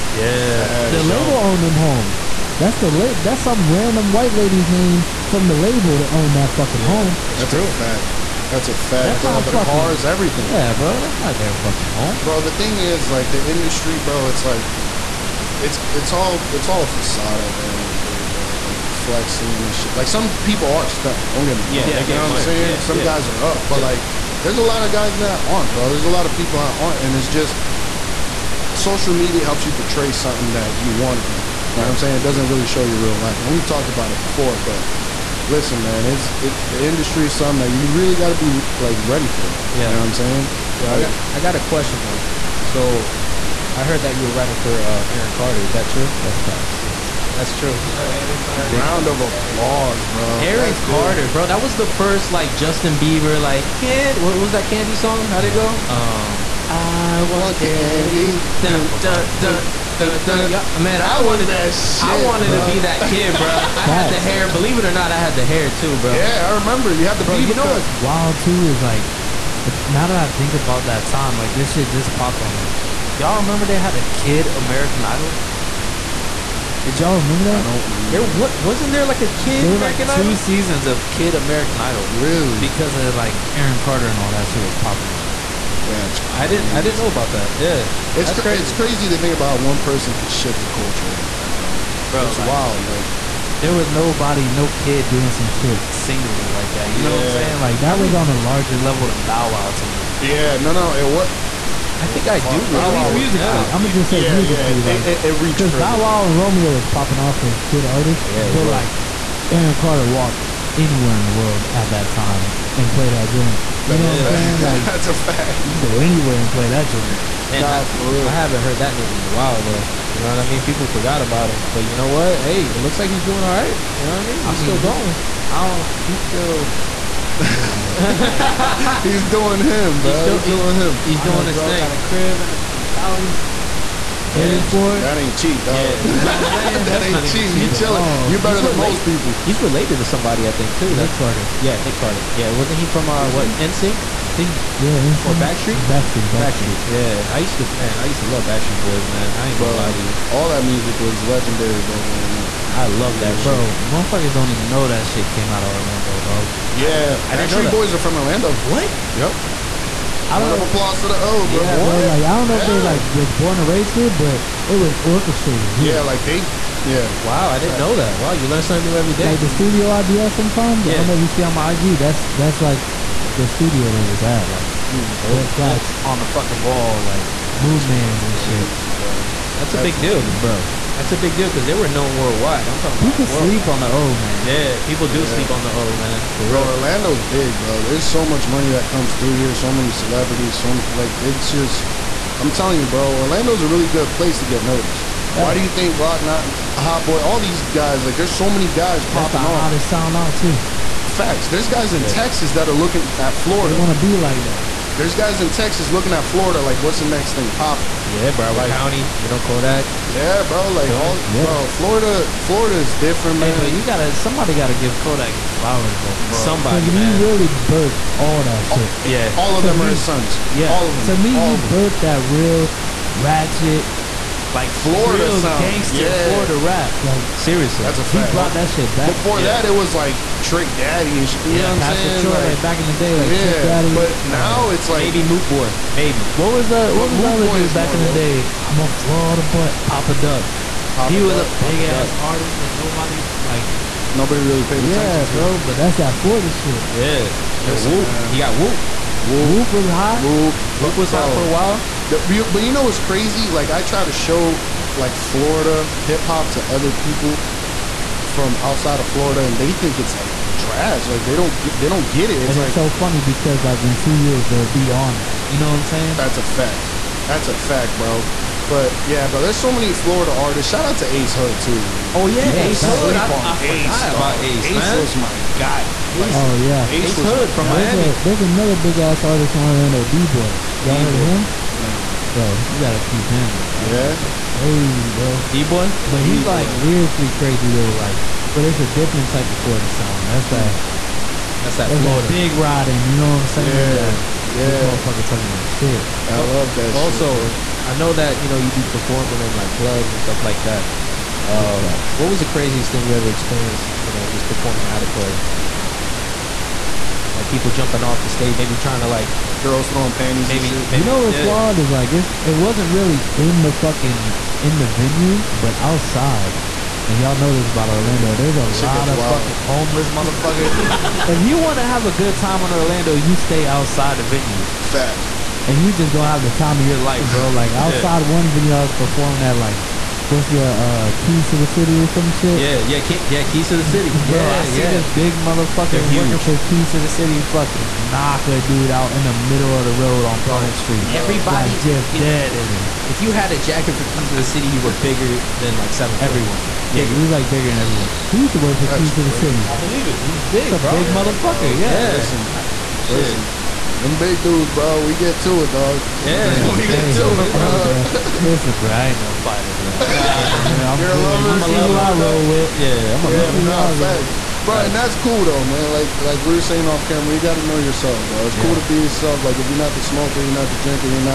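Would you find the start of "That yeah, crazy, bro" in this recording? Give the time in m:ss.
4:43.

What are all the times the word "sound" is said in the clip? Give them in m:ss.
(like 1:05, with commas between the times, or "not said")
3:19, 3:45, 4:49.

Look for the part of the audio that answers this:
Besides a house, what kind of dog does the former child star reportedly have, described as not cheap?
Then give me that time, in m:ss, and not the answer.
2:12.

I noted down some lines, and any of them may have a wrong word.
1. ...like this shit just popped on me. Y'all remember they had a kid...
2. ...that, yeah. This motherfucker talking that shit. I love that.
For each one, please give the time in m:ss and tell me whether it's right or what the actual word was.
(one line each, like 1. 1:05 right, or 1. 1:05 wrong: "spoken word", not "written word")
1. 1:11 right
2. 4:53 right.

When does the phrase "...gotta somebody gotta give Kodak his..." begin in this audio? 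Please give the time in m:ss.
3:33.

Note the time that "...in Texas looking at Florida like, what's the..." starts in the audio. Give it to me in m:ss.
3:25.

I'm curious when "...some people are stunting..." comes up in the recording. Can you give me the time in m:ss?
0:20.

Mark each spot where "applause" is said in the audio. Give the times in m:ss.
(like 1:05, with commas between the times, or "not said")
0:49, 2:40.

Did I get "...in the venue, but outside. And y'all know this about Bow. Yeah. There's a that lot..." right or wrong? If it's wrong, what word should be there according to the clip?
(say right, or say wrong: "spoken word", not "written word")
wrong: "Orlando", not "Bow".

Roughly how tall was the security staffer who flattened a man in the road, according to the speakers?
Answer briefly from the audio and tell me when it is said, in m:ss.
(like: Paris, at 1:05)
7 foot, at 5:45.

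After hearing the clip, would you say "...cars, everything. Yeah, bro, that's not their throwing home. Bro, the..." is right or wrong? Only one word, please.
wrong.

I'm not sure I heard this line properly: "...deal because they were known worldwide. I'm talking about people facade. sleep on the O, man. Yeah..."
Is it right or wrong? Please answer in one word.
wrong.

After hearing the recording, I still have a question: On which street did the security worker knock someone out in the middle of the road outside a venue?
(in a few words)
Pine Street.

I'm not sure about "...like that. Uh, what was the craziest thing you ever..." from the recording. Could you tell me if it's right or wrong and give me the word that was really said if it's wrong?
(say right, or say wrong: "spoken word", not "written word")
right.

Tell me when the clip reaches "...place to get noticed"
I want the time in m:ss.
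3:14.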